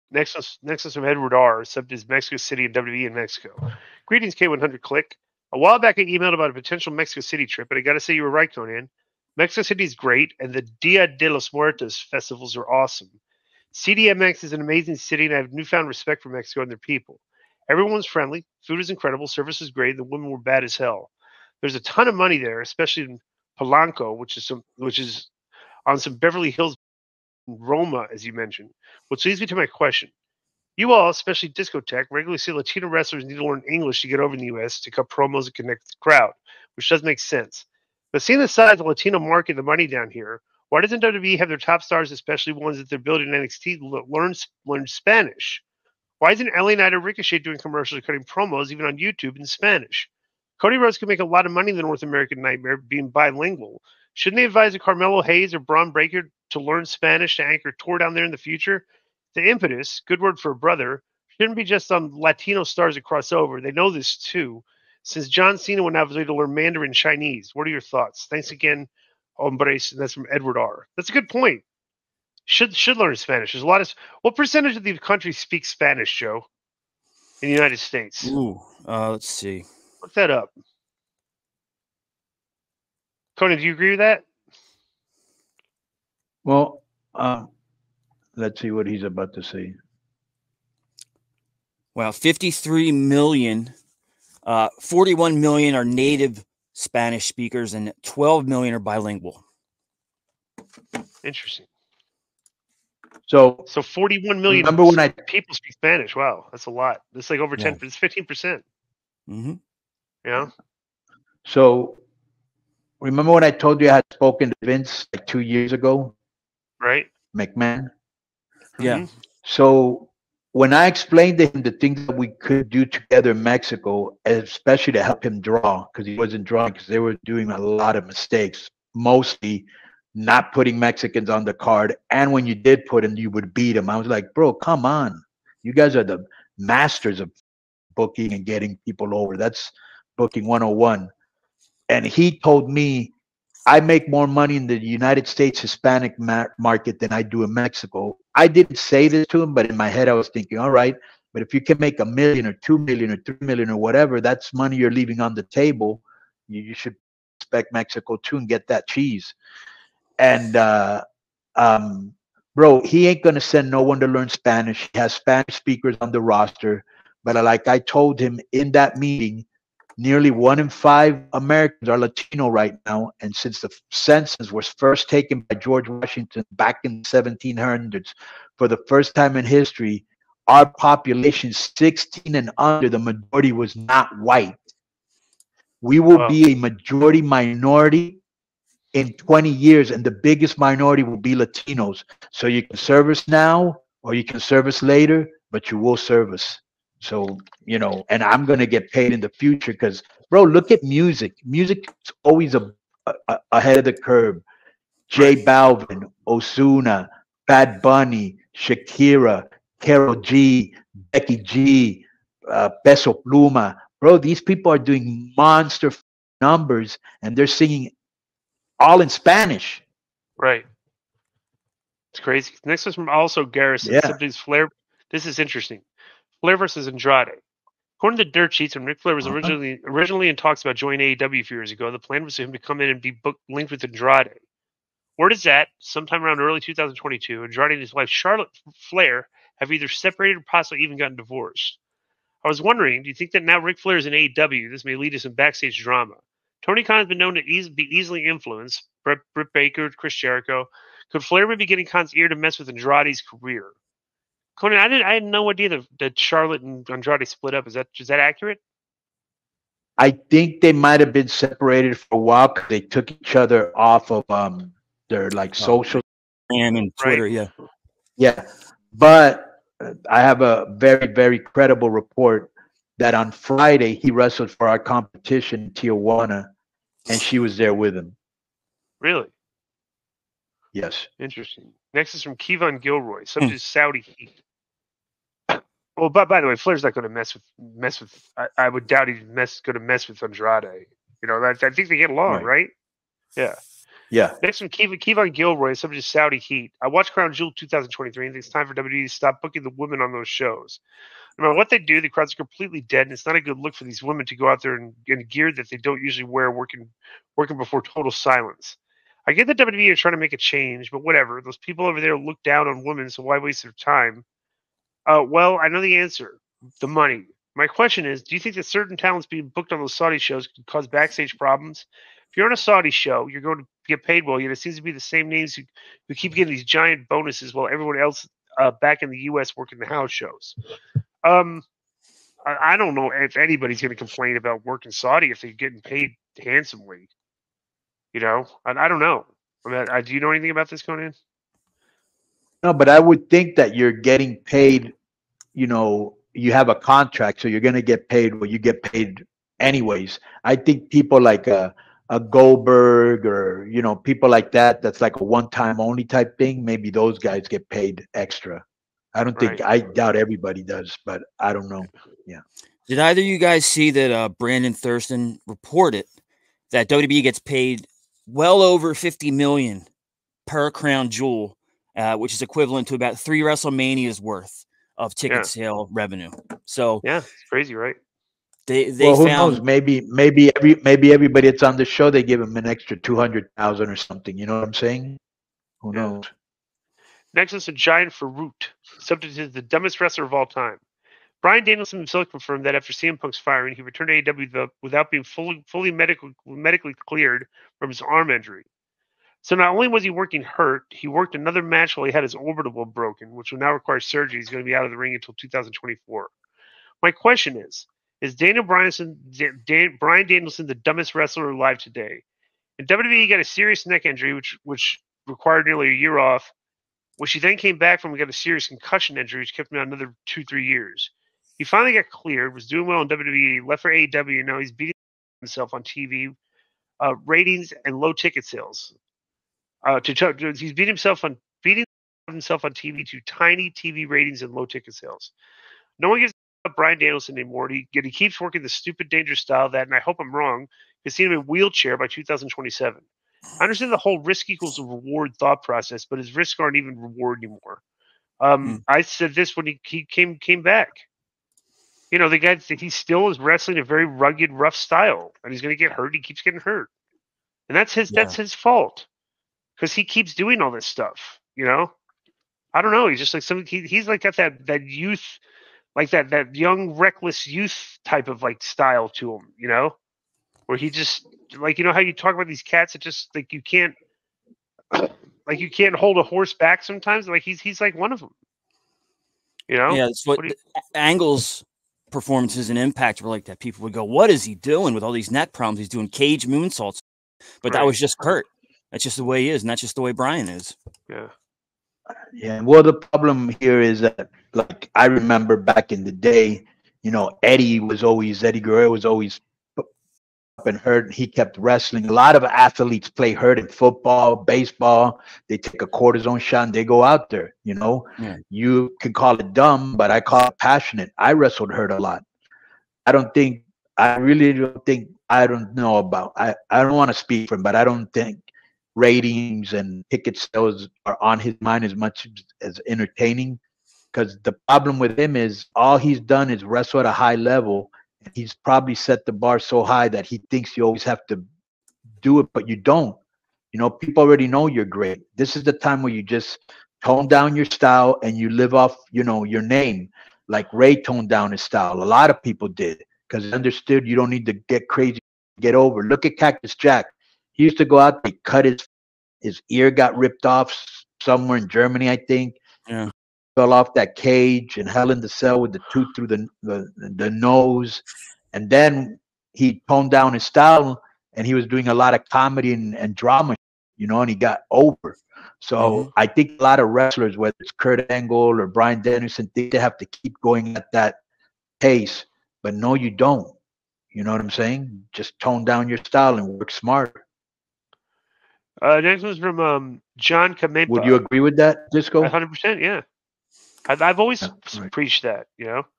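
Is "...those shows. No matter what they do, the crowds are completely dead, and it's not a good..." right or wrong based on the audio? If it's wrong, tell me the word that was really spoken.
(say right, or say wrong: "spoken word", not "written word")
right.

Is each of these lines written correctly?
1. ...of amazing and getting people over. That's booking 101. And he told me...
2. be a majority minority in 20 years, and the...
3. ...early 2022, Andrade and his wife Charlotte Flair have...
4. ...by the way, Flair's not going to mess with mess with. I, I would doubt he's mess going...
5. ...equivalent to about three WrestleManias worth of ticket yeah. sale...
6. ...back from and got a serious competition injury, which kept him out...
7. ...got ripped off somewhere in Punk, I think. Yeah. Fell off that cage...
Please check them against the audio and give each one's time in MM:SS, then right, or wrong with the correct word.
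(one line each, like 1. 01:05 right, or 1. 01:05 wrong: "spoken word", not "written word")
1. 02:17 wrong: "booking", not "amazing"
2. 03:06 right
3. 03:56 right
4. 04:46 right
5. 06:12 right
6. 06:57 wrong: "concussion", not "competition"
7. 09:09 wrong: "Germany", not "Punk".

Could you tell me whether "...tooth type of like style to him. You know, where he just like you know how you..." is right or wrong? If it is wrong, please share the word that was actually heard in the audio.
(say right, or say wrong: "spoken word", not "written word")
wrong: "youth", not "tooth".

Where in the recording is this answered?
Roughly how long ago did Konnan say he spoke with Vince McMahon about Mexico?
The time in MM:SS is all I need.
01:55.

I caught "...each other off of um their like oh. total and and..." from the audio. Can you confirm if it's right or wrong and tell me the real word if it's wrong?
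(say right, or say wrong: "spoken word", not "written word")
wrong: "social", not "total".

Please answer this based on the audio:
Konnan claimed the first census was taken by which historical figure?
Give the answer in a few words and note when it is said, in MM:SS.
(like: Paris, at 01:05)
George Washington, at 02:55.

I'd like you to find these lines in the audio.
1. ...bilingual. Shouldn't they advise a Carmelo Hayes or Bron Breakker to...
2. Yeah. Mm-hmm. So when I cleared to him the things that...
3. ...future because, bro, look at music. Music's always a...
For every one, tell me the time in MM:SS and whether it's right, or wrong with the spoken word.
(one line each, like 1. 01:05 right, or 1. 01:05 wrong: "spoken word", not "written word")
1. 00:53 right
2. 01:58 wrong: "explained", not "cleared"
3. 03:19 right.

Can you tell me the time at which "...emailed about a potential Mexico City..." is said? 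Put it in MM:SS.
00:06.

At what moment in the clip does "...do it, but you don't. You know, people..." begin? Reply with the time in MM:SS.
08:52.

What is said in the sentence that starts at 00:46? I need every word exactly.
Why isn't LA Knight or Ricochet doing commercials or cutting promos, even on YouTube, in Spanish?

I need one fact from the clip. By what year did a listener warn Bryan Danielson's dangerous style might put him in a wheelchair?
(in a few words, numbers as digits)
2027.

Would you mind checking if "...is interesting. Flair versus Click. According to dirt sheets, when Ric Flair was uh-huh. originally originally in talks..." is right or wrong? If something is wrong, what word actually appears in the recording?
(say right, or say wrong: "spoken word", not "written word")
wrong: "Andrade", not "Click".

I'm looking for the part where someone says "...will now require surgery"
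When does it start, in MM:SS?
06:43.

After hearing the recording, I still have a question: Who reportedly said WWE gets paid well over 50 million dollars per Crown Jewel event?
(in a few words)
Brandon Thurston.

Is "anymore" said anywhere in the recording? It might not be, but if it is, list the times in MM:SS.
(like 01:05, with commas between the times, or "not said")
07:17, 07:27.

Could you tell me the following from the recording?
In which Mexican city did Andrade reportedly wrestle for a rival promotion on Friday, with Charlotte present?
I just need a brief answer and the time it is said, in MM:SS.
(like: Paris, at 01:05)
Tijuana, at 04:35.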